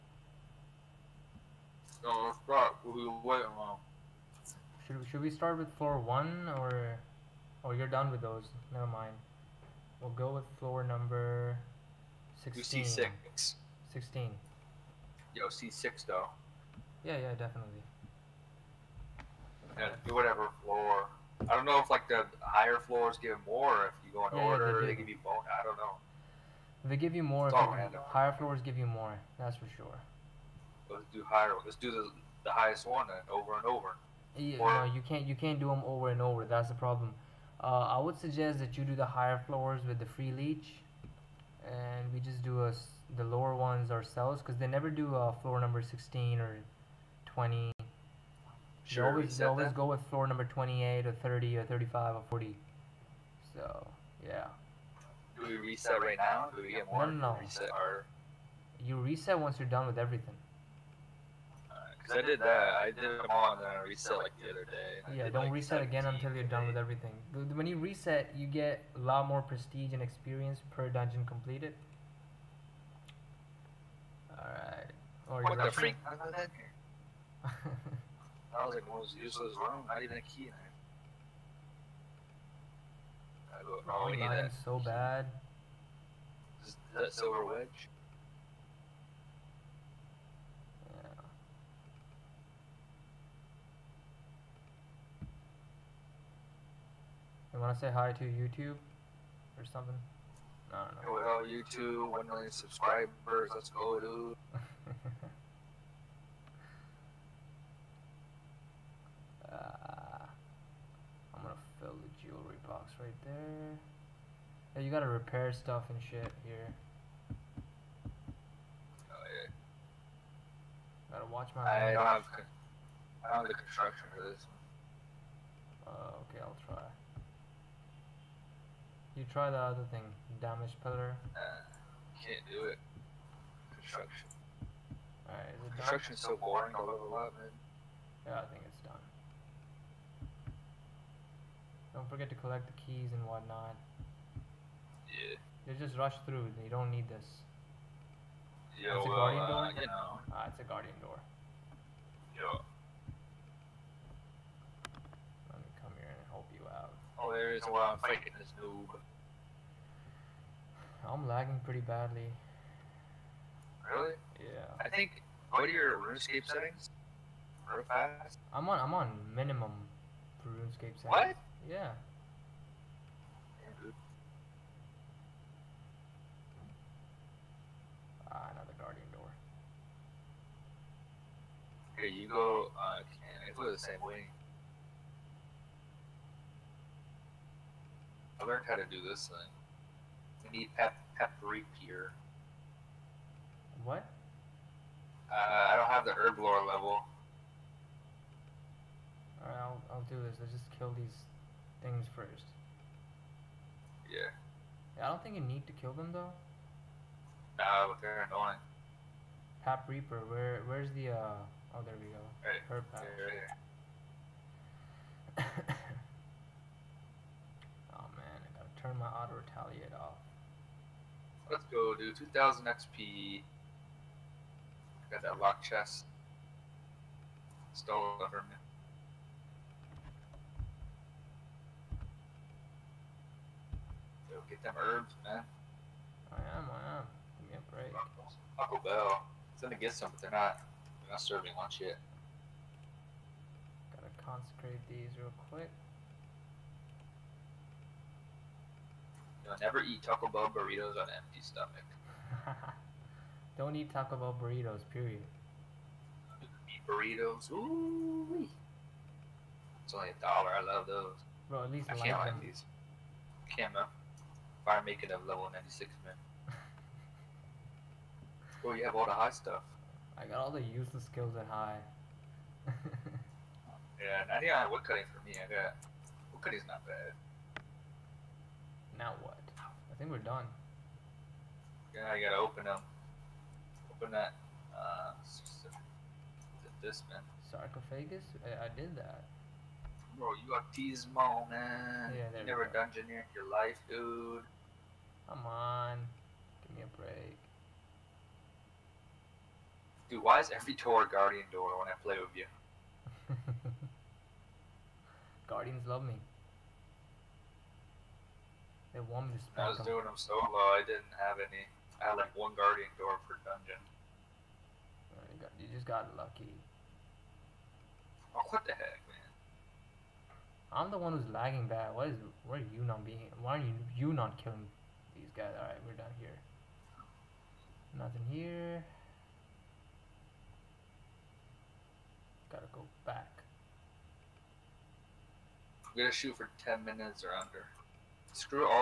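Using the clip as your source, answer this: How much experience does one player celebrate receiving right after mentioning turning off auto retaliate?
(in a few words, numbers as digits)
2000.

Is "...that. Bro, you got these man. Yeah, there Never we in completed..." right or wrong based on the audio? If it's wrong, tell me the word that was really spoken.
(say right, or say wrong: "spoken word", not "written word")
wrong: "dungeoneered", not "completed".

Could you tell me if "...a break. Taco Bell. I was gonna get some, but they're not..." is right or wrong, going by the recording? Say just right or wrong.
right.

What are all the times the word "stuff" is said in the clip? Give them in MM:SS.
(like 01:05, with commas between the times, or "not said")
01:55, 04:29.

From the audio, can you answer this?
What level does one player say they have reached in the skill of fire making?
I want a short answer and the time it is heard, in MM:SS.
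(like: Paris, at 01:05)
96, at 04:25.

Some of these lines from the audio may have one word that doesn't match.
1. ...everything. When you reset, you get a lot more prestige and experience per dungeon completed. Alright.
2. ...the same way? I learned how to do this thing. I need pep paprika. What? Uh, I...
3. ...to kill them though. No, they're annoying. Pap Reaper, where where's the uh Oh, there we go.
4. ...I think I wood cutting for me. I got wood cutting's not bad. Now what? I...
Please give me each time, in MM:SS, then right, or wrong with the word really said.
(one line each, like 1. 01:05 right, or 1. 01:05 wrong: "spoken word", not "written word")
1. 01:06 right
2. 03:03 right
3. 03:25 right
4. 04:34 right.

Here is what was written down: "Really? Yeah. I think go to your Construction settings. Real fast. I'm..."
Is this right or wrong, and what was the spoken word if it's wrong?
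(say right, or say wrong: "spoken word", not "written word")
wrong: "RuneScape", not "Construction".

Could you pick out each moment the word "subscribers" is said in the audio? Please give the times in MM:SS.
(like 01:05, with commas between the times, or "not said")
01:42.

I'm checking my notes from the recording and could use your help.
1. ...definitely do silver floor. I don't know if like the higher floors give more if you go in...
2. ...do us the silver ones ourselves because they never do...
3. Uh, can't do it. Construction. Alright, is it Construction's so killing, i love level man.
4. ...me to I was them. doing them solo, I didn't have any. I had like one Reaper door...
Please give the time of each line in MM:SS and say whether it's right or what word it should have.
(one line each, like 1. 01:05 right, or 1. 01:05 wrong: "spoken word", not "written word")
1. 00:17 wrong: "whatever", not "silver"
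2. 00:42 wrong: "lower", not "silver"
3. 02:11 wrong: "boring", not "killing"
4. 05:09 wrong: "Guardian", not "Reaper".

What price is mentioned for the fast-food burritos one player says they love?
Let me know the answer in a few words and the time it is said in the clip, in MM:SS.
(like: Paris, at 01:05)
a dollar, at 04:19.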